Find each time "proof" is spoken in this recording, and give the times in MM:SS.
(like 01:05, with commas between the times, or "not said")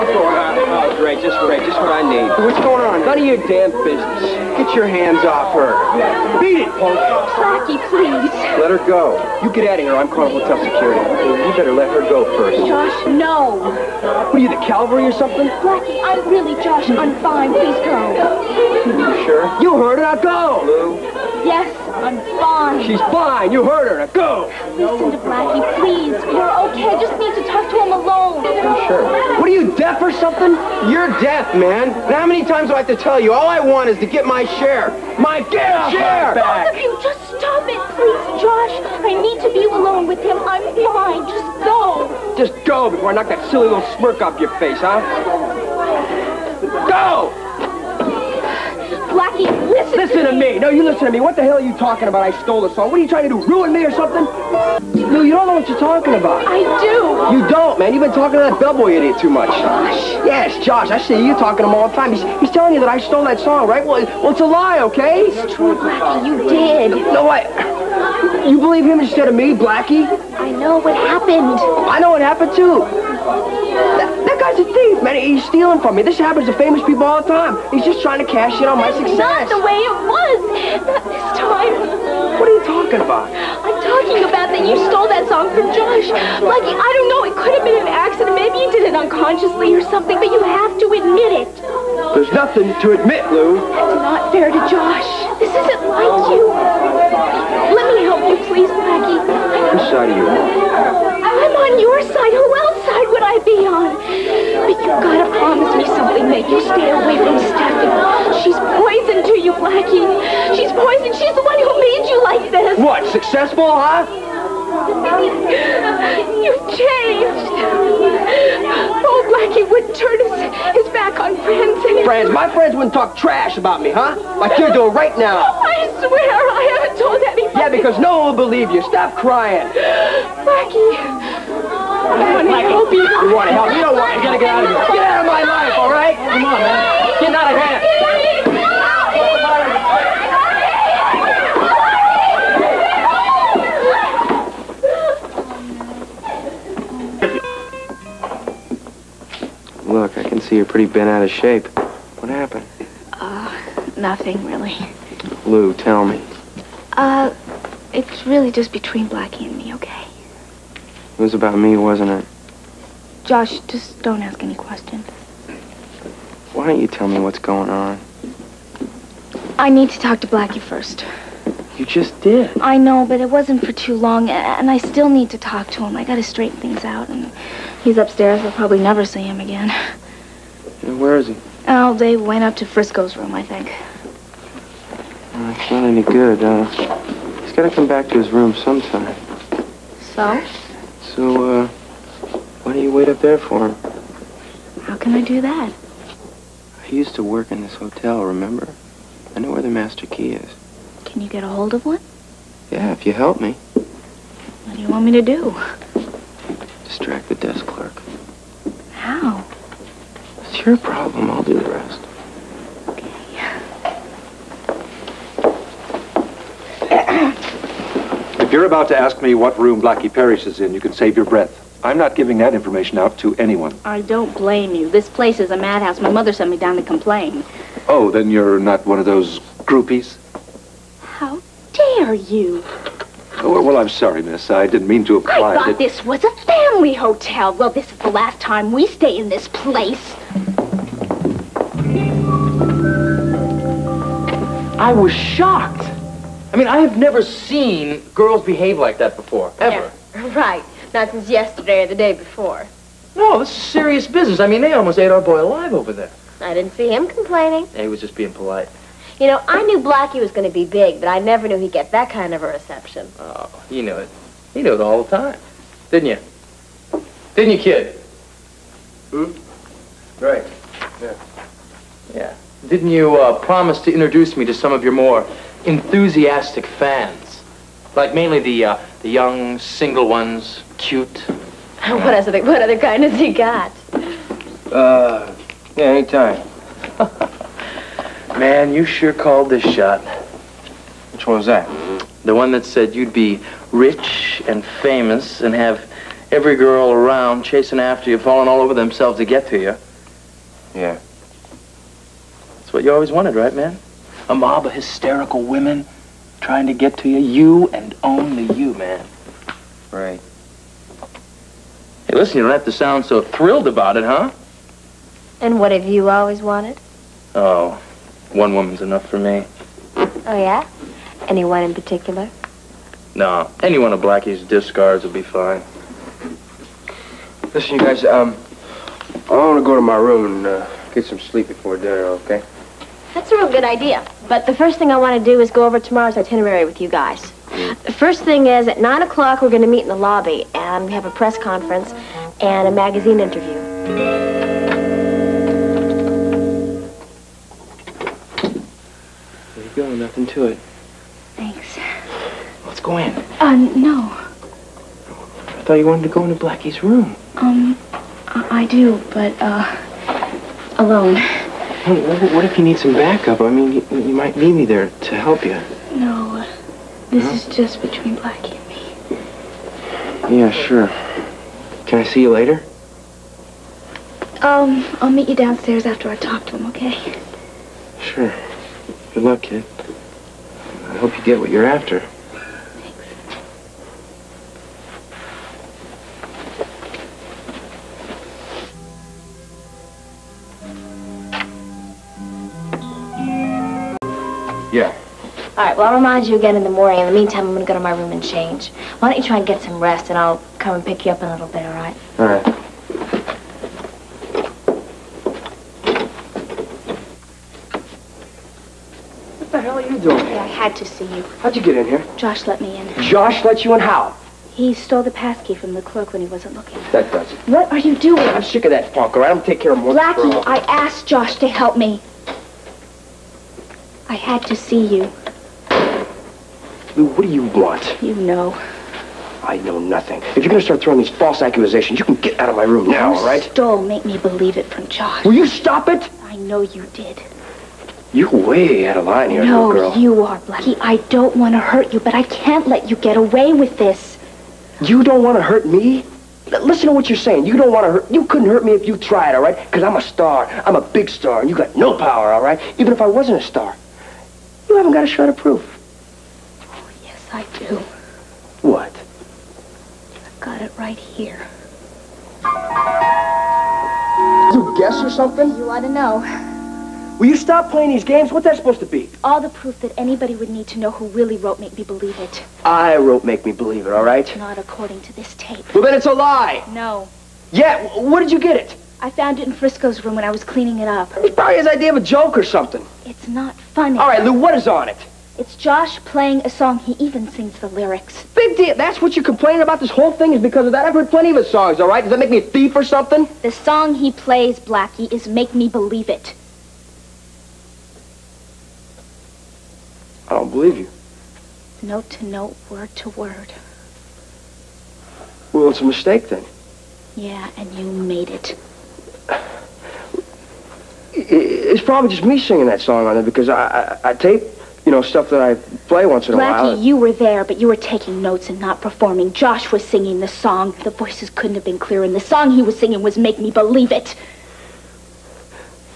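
07:35, 07:49.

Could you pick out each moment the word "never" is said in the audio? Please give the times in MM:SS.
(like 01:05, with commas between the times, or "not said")
02:58, 04:06, 04:21.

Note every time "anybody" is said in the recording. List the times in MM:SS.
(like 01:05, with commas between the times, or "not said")
02:07, 07:49.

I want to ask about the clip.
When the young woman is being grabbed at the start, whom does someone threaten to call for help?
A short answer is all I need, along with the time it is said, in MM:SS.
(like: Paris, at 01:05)
hotel security, at 00:10.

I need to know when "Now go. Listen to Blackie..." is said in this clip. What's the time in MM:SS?
00:23.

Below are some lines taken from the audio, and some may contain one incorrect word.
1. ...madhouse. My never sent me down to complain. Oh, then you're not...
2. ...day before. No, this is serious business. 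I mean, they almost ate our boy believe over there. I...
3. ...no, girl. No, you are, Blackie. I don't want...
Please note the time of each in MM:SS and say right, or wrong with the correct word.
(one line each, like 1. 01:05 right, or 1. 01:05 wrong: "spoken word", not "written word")
1. 03:45 wrong: "mother", not "never"
2. 04:11 wrong: "alive", not "believe"
3. 07:19 right.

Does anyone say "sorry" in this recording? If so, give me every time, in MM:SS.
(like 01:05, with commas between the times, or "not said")
01:39, 03:53.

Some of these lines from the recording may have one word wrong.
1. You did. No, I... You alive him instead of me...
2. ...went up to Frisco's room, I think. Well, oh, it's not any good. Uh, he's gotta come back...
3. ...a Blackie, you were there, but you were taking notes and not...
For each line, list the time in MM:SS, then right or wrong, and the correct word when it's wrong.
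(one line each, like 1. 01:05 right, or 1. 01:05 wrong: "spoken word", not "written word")
1. 01:06 wrong: "believe", not "alive"
2. 03:02 right
3. 08:36 right.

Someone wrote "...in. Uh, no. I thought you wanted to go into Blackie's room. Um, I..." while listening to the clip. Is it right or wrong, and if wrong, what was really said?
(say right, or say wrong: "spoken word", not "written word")
right.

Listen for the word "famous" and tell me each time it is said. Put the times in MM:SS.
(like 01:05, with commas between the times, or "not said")
01:16, 04:54.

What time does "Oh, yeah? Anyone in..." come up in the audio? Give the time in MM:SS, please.
05:19.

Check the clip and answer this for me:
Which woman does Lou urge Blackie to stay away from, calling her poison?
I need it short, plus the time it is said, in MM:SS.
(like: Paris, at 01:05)
Stephanie, at 01:47.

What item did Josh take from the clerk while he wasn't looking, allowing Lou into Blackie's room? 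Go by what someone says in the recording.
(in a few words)
the passkey.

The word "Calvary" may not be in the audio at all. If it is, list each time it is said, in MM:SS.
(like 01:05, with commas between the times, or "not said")
00:14.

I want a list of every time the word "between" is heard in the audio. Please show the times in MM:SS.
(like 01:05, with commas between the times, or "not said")
02:38, 06:07.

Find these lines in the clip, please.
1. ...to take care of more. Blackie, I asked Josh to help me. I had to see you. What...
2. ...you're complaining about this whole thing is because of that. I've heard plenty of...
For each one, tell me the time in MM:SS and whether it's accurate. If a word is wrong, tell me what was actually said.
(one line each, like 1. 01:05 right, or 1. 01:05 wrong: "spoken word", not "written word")
1. 06:59 right
2. 08:09 right.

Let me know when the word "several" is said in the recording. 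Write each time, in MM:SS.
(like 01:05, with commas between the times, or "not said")
not said.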